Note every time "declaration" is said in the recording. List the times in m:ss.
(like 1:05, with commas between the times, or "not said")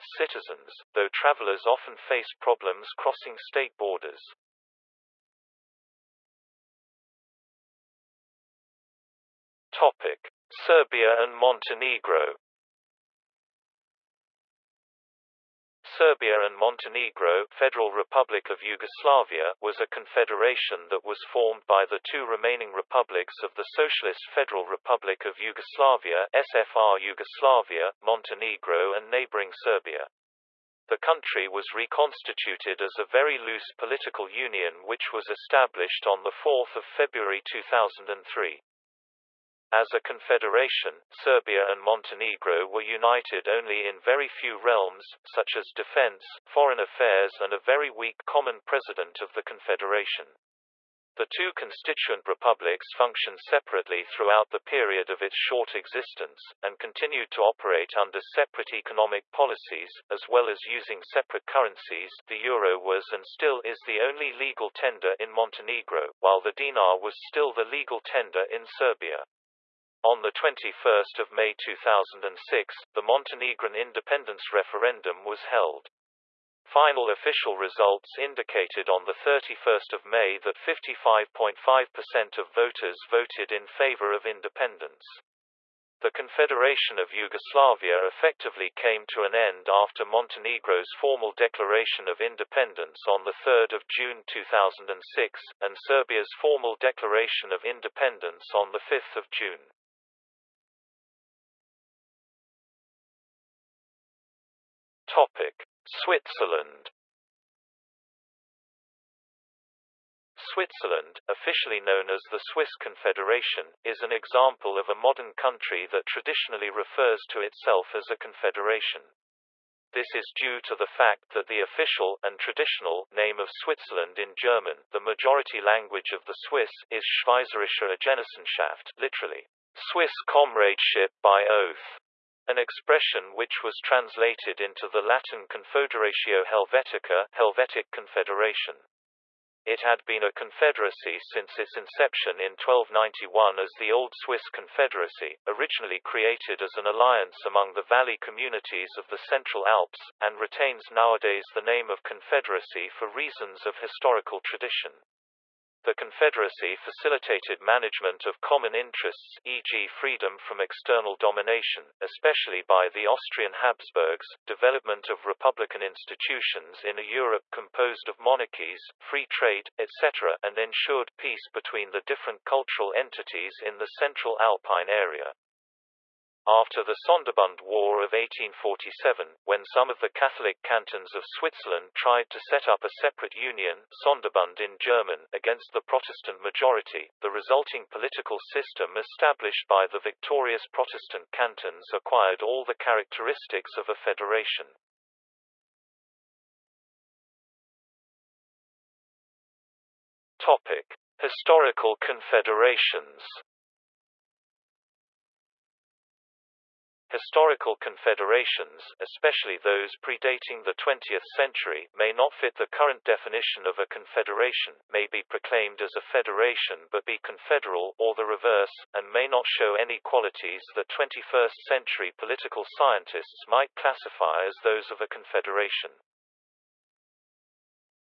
1:31, 1:36.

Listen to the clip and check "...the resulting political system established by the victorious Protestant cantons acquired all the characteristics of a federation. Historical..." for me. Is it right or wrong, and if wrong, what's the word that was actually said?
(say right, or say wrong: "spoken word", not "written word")
right.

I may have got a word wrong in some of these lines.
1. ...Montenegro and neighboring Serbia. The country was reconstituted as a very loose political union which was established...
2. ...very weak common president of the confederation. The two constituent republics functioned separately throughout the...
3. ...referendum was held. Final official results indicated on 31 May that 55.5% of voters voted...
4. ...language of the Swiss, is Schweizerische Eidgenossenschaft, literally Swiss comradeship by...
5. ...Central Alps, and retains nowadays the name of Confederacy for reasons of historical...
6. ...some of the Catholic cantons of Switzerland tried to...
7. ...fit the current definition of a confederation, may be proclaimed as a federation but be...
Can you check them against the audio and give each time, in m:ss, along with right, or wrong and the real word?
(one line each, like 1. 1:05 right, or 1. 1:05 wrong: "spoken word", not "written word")
1. 0:28 right
2. 0:47 right
3. 1:14 right
4. 2:05 right
5. 2:29 right
6. 2:59 right
7. 3:32 right.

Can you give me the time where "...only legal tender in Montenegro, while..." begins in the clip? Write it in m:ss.
1:03.